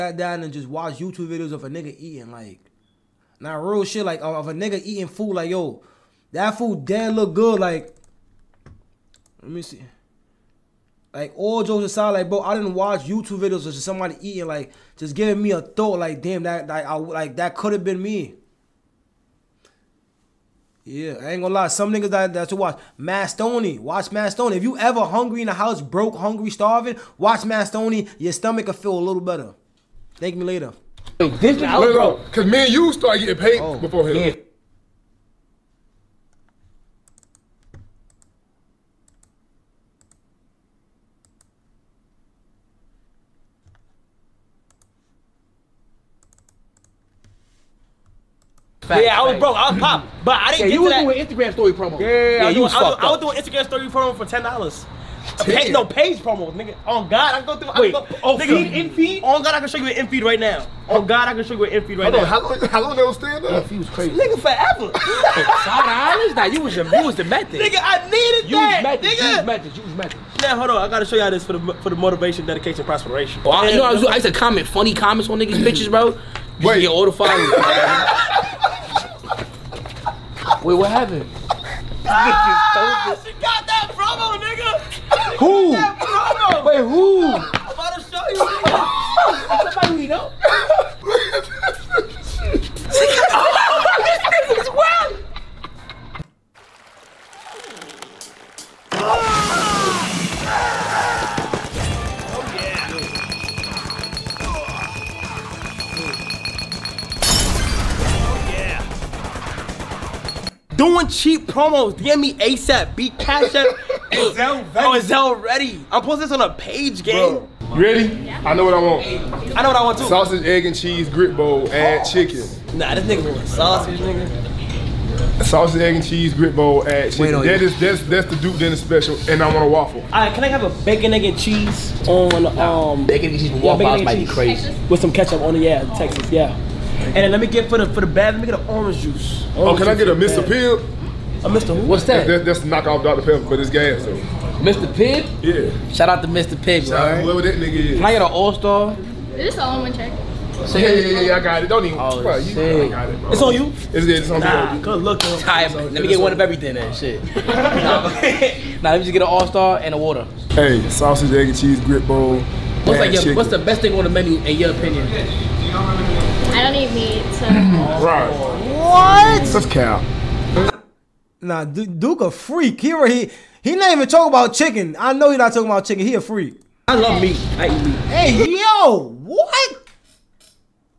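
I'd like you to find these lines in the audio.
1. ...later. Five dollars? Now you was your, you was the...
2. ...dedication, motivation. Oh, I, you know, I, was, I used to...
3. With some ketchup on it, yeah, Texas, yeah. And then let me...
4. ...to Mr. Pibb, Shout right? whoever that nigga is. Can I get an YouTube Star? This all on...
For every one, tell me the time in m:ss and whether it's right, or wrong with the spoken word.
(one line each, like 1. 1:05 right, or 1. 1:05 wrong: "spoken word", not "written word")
1. 1:04 wrong: "forever", not "later"
2. 1:12 wrong: "prosperation", not "motivation"
3. 2:14 right
4. 2:26 wrong: "All", not "YouTube".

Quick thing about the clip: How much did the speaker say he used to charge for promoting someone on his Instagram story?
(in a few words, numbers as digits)
$10.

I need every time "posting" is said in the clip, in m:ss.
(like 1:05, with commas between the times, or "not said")
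1:56.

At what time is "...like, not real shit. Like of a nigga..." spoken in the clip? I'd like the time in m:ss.
0:02.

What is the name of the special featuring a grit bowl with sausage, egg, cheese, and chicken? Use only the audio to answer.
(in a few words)
Duke dinner special.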